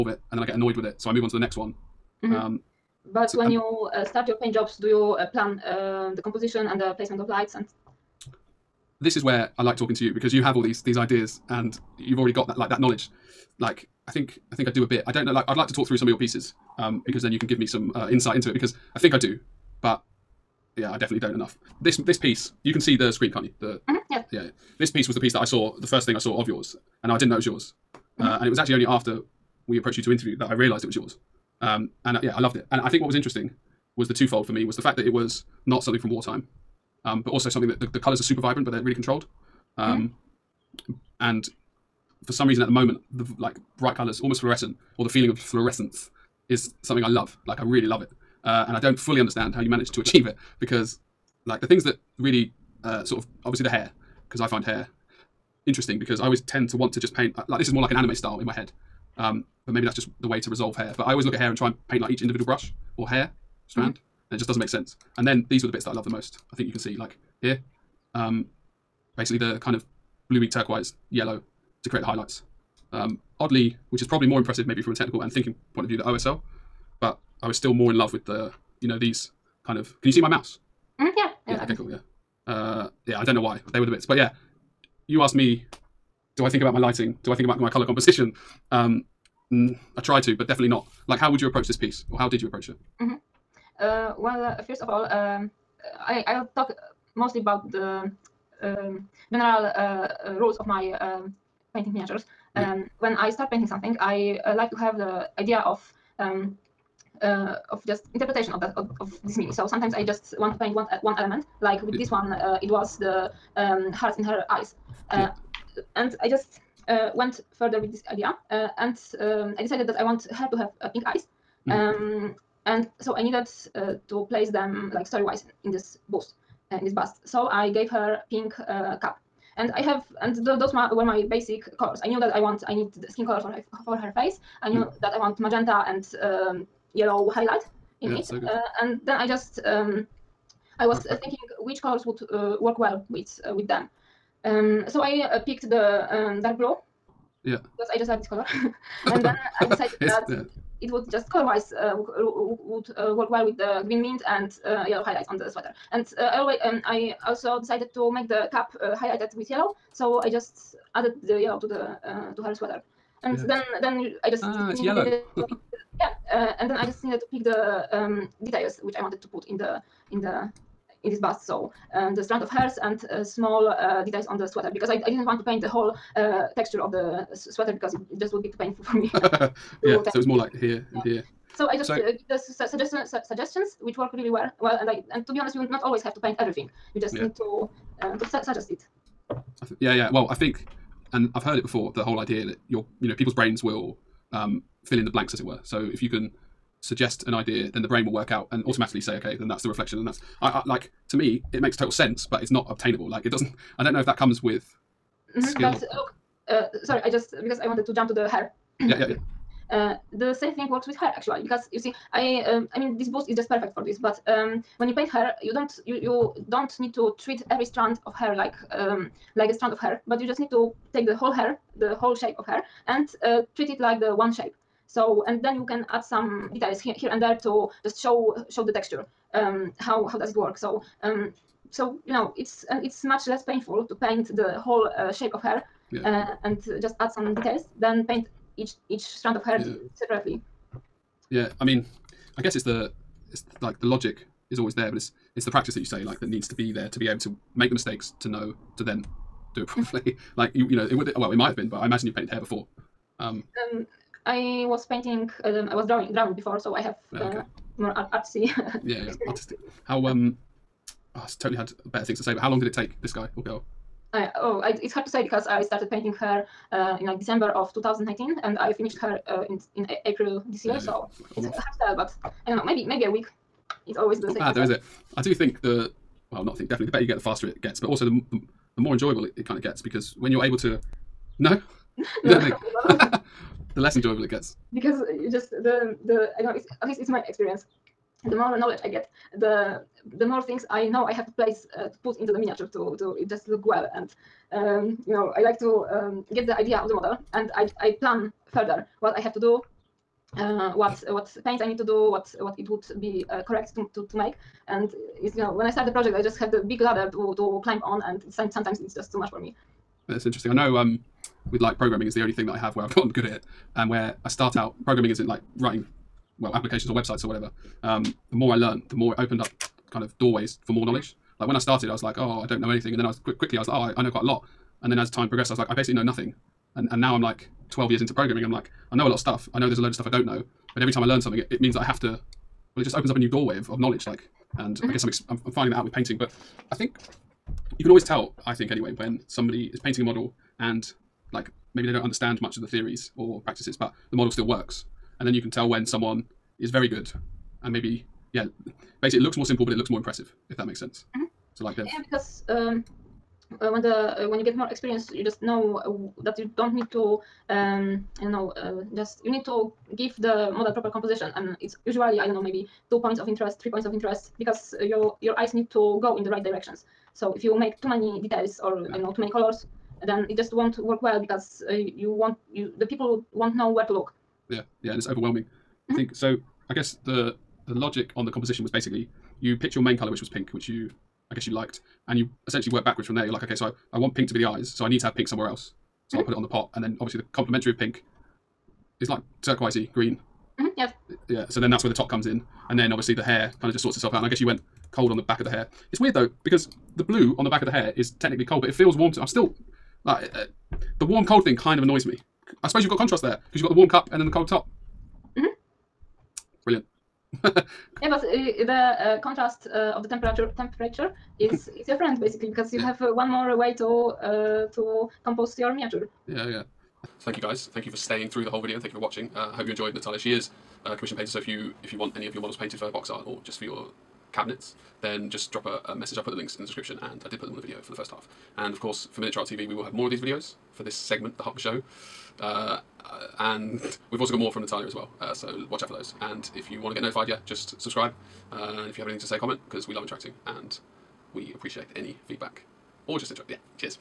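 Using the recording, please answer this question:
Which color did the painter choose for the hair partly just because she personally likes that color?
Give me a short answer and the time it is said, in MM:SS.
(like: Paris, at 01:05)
dark blue, at 02:26.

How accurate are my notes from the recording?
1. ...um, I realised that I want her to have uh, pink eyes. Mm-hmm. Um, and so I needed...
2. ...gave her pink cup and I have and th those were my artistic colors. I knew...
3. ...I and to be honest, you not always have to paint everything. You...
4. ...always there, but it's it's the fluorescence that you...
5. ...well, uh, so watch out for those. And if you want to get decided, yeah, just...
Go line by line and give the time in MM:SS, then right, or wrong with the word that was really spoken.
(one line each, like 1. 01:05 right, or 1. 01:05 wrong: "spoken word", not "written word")
1. 01:59 wrong: "decided", not "realised"
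2. 02:07 wrong: "basic", not "artistic"
3. 03:04 right
4. 04:04 wrong: "practice", not "fluorescence"
5. 07:14 wrong: "notified", not "decided".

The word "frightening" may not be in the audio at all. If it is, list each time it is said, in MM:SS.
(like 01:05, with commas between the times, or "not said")
not said.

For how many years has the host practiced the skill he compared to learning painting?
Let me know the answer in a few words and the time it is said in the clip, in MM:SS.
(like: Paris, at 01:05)
12, at 05:27.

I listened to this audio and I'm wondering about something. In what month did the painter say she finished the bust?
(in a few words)
April.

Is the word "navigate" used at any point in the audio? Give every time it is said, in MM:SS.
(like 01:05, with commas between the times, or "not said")
not said.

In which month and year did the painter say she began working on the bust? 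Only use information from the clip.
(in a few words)
December 2019.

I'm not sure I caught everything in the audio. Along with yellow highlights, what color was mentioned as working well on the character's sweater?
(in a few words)
green mint.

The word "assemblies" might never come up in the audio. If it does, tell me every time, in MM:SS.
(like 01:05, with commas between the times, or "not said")
not said.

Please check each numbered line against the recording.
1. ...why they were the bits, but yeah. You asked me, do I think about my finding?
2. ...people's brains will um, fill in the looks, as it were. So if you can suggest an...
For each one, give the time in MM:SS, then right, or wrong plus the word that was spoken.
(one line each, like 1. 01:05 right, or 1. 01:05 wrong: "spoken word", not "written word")
1. 01:23 wrong: "lighting", not "finding"
2. 03:13 wrong: "blanks", not "looks".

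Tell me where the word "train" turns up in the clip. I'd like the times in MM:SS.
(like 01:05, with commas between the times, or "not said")
not said.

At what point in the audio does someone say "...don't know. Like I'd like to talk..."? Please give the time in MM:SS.
00:15.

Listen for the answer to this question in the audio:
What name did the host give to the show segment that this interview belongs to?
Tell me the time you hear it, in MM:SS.
07:11.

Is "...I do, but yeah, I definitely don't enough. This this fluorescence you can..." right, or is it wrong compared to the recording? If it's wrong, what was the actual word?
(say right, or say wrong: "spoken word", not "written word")
wrong: "piece", not "fluorescence".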